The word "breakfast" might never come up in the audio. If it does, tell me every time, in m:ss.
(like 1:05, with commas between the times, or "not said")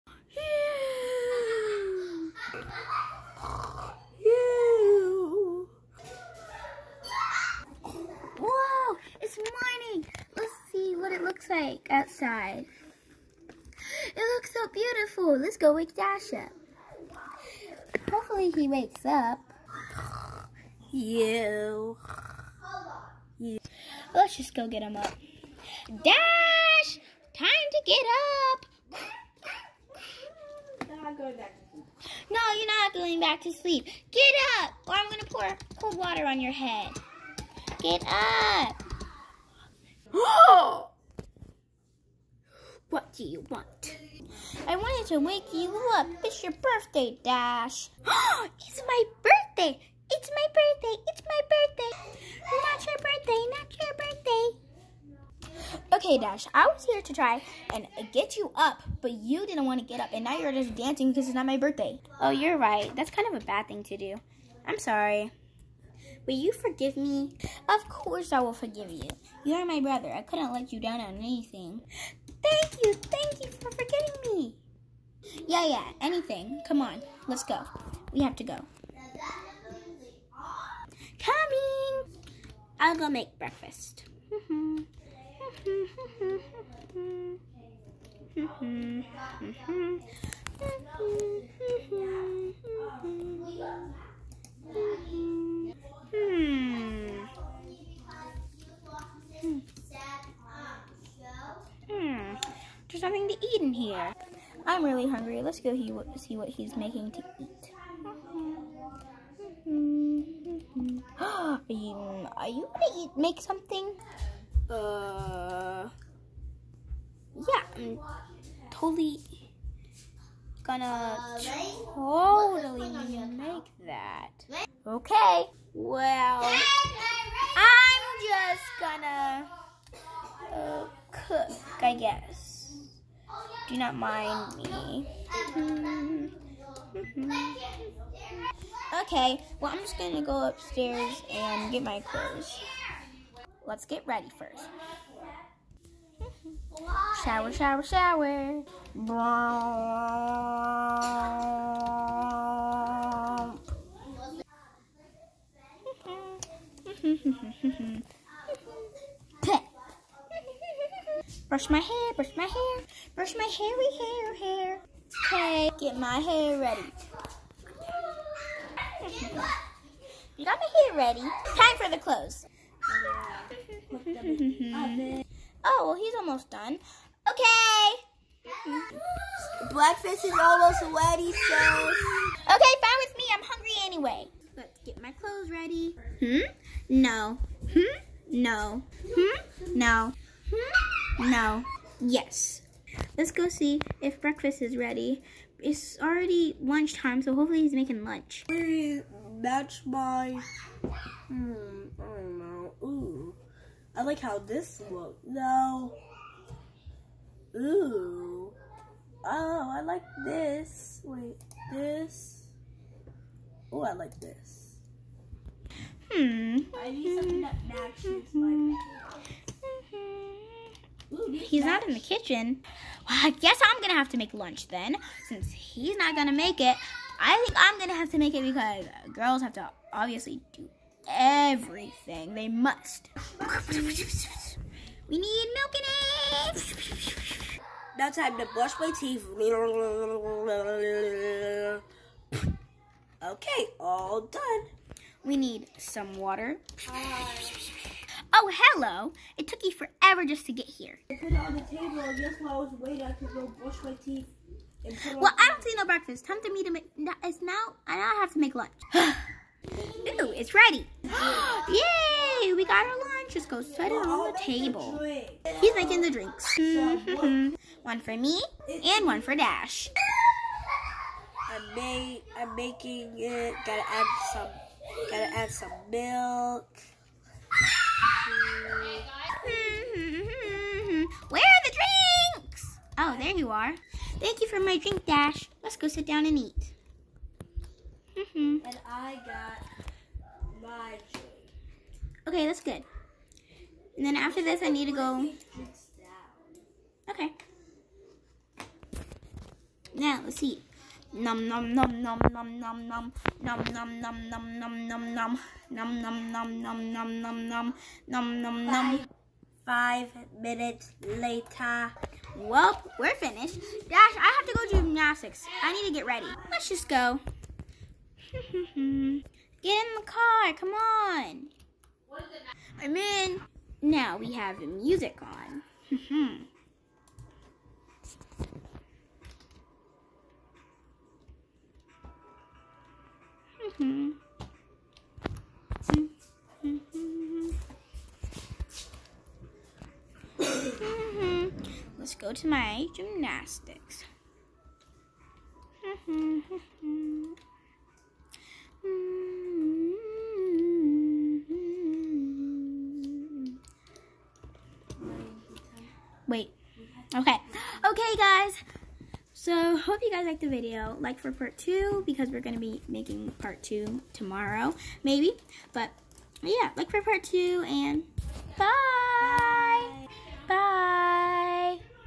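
1:23, 2:59, 3:14, 4:15.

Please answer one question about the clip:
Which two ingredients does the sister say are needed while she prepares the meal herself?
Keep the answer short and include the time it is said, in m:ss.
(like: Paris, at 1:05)
milk and eggs, at 3:55.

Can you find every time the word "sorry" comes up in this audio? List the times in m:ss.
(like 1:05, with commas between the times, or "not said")
1:04.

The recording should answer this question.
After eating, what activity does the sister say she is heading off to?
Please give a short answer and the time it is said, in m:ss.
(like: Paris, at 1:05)
gymnastics, at 5:42.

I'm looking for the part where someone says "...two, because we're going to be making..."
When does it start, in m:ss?
6:01.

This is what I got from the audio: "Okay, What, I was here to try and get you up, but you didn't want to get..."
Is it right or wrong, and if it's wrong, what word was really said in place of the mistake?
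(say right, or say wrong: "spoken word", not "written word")
wrong: "Dash", not "What".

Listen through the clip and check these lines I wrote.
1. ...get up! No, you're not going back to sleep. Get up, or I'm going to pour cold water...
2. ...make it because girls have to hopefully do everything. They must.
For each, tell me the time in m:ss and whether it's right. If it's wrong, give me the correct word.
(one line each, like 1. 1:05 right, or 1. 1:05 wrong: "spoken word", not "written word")
1. 0:27 right
2. 3:48 wrong: "obviously", not "hopefully".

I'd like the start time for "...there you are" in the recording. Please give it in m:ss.
4:43.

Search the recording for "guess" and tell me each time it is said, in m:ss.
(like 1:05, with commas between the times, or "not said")
2:11, 3:43, 4:12.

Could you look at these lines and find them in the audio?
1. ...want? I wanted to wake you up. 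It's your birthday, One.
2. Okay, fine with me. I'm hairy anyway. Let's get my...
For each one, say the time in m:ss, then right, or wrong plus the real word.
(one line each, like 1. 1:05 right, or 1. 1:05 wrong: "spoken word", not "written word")
1. 0:43 wrong: "Dash", not "One"
2. 3:02 wrong: "hungry", not "hairy".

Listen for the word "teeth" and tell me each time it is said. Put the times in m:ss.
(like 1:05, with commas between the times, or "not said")
3:58, 4:14.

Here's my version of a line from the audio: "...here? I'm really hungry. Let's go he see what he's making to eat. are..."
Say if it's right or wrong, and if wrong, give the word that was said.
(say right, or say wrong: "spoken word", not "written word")
right.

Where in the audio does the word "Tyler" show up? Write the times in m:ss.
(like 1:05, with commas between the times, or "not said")
not said.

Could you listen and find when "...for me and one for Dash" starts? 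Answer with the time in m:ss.
4:28.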